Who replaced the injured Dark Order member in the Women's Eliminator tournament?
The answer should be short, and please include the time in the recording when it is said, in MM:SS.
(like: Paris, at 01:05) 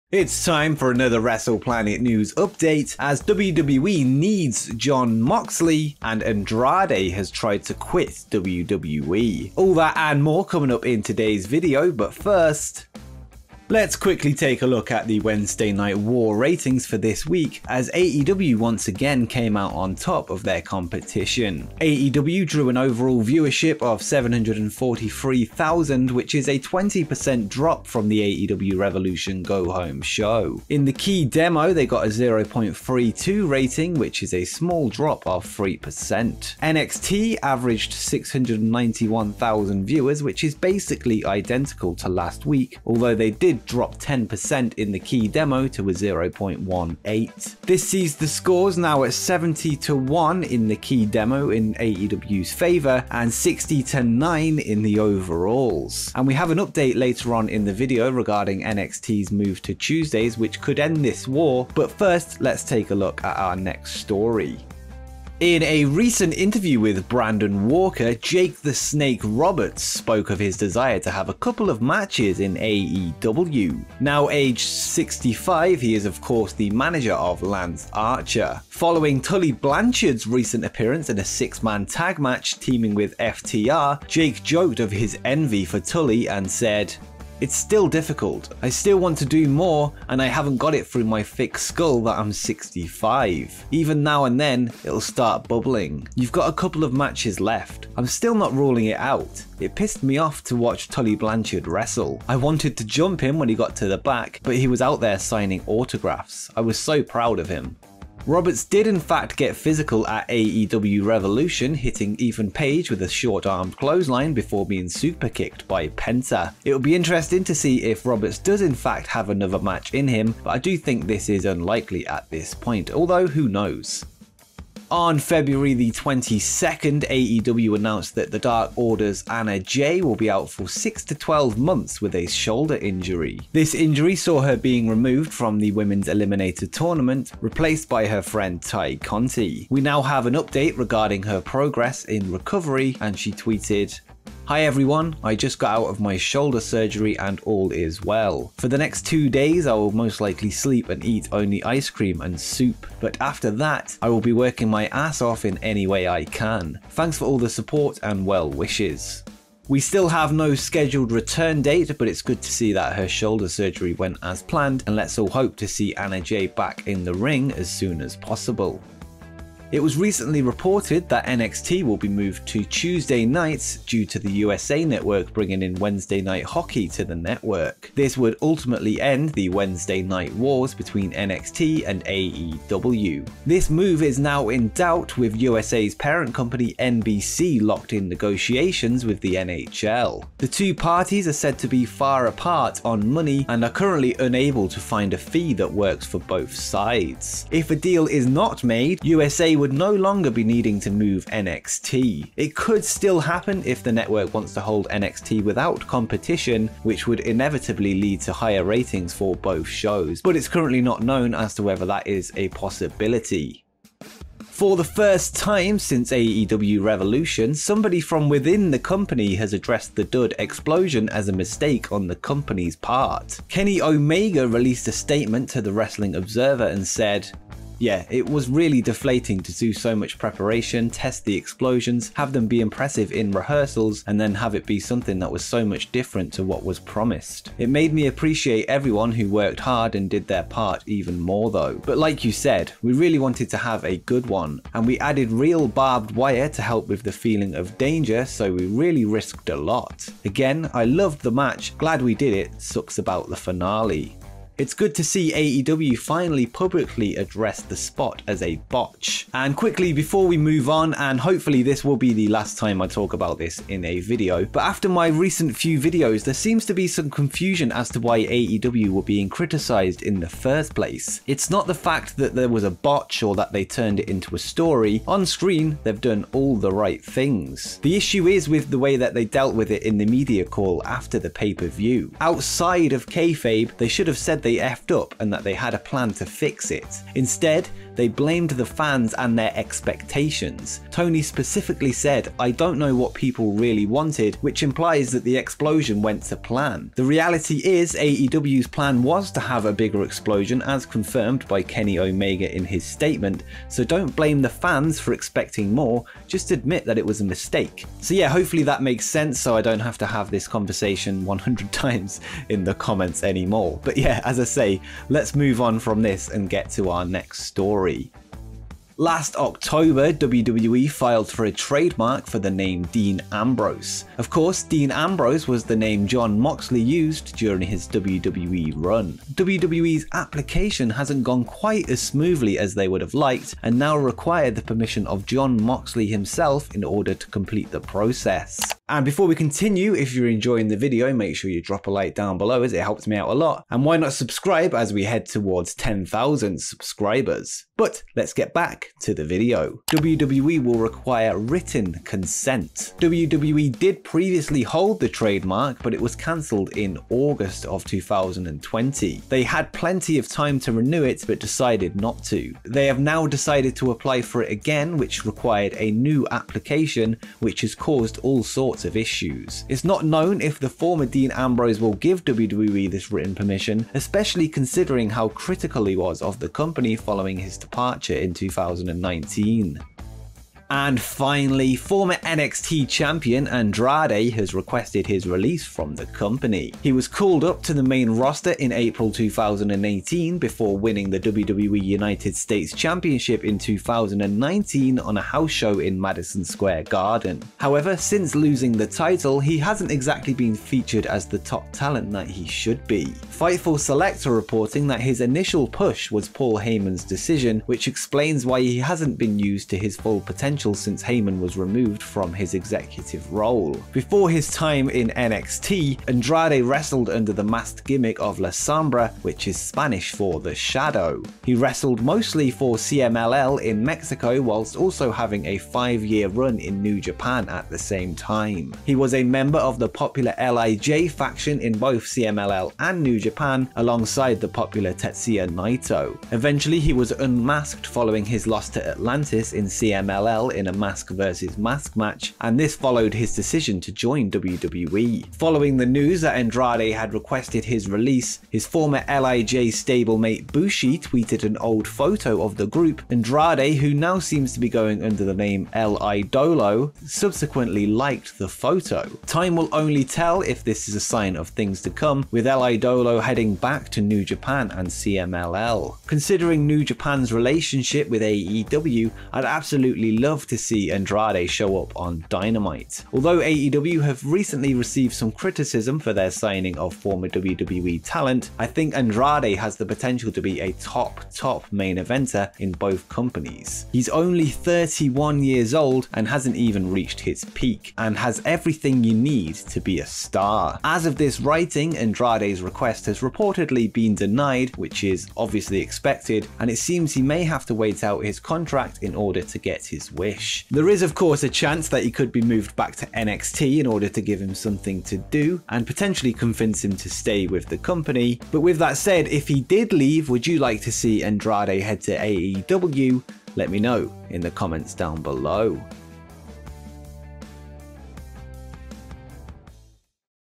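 Tay Conti, at 02:18.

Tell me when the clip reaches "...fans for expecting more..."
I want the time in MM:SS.
05:04.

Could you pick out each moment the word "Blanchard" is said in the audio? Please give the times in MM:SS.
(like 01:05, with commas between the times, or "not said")
01:19, 01:41.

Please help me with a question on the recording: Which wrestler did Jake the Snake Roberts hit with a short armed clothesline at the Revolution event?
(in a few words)
Ethan Page.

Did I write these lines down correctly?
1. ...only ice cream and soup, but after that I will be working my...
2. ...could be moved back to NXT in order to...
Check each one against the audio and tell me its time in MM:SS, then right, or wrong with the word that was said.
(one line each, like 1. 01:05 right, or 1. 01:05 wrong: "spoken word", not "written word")
1. 02:31 right
2. 08:22 right.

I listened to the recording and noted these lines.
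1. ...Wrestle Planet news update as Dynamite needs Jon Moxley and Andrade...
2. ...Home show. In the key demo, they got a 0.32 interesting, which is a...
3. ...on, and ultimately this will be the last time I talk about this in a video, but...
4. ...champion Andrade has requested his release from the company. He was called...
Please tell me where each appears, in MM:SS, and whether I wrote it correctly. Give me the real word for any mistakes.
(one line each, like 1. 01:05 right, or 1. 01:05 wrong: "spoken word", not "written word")
1. 00:01 wrong: "WWE", not "Dynamite"
2. 00:29 wrong: "rating", not "interesting"
3. 04:20 wrong: "hopefully", not "ultimately"
4. 06:22 right.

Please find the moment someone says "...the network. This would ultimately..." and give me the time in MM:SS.
02:57.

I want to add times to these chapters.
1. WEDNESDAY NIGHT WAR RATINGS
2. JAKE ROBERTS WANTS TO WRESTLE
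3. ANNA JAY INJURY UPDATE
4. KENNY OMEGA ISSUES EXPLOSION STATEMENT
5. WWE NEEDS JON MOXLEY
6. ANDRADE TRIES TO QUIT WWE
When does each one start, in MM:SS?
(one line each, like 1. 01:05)
1. 00:13
2. 01:05
3. 02:04
4. 03:34
5. 05:18
6. 06:20.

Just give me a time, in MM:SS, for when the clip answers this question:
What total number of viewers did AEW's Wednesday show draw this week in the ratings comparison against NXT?
00:24.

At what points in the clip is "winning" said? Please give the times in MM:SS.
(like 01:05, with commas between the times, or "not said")
06:30.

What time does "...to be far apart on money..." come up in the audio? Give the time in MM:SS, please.
03:11.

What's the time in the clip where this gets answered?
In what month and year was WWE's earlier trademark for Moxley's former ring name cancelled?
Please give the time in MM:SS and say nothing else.
05:57.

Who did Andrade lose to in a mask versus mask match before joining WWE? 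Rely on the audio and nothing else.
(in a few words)
Atlantis.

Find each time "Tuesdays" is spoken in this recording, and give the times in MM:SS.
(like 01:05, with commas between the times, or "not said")
00:59, 02:52.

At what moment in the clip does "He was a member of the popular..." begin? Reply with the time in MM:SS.
07:08.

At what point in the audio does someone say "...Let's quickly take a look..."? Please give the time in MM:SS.
00:13.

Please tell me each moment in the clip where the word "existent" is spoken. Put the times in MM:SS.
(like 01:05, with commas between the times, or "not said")
not said.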